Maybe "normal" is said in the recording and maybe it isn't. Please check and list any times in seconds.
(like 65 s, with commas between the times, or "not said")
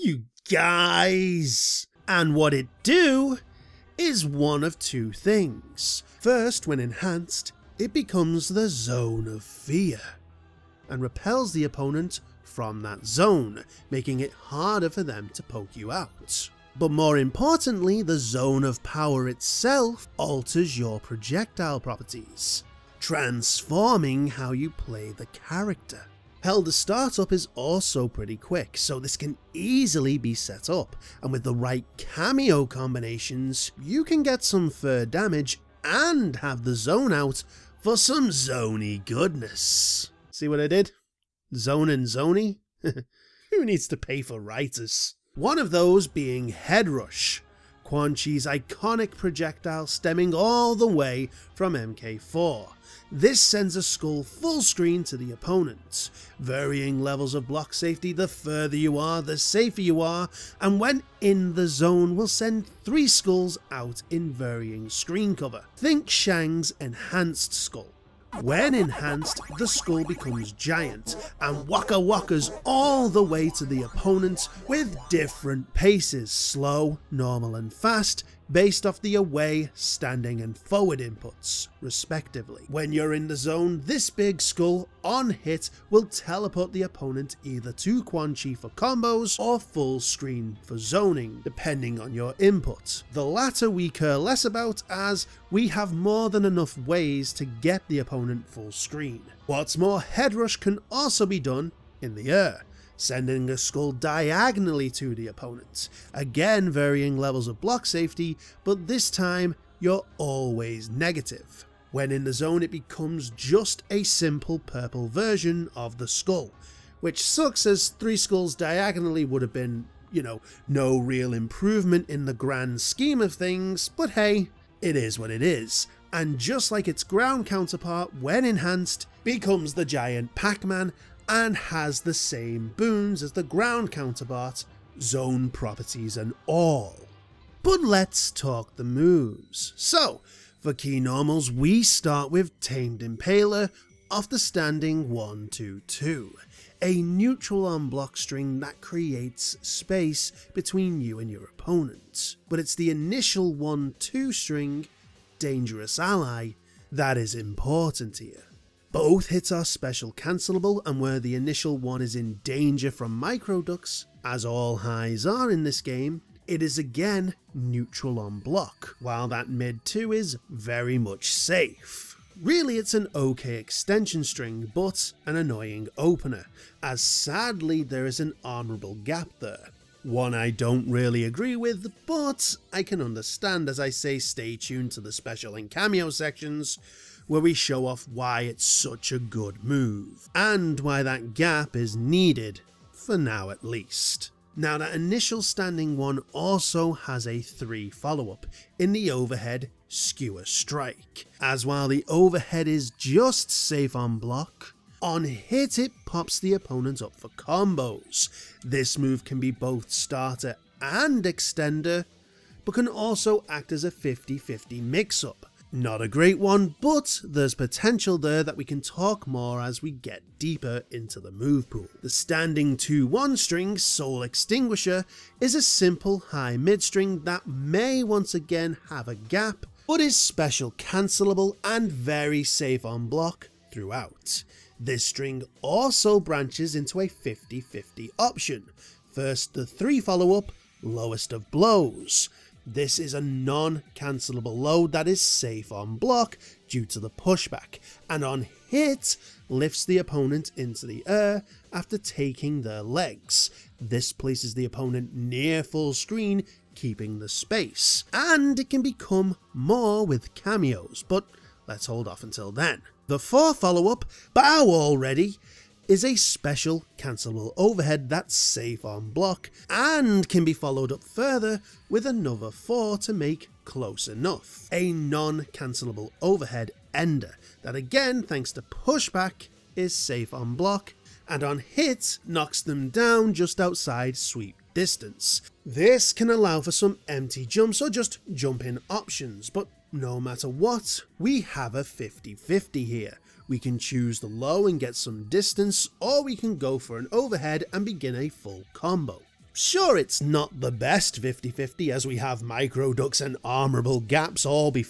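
77 s, 140 s.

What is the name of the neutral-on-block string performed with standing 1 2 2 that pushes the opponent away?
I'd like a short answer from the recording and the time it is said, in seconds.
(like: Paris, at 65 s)
Tamed Impaler, at 142 s.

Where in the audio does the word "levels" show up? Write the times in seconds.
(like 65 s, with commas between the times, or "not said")
57 s, 107 s.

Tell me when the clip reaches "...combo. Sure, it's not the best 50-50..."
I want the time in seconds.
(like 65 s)
298 s.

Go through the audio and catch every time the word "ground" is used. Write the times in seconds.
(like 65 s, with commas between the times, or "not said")
127 s, 133 s.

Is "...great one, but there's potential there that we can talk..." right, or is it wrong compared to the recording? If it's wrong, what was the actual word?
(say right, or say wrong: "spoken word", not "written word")
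right.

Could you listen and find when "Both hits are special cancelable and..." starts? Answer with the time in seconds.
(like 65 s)
158 s.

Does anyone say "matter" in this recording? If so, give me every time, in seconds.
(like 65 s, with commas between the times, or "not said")
290 s.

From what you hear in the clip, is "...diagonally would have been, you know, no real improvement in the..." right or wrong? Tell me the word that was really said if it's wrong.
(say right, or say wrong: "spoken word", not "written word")
right.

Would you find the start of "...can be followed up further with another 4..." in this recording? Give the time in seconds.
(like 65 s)
270 s.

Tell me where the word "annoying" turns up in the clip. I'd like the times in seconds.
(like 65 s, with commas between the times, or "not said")
175 s.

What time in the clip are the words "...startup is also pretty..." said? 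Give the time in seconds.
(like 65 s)
26 s.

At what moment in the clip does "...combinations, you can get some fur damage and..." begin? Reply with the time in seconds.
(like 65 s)
32 s.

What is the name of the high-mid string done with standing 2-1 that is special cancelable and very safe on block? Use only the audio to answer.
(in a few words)
Soul Extinguisher.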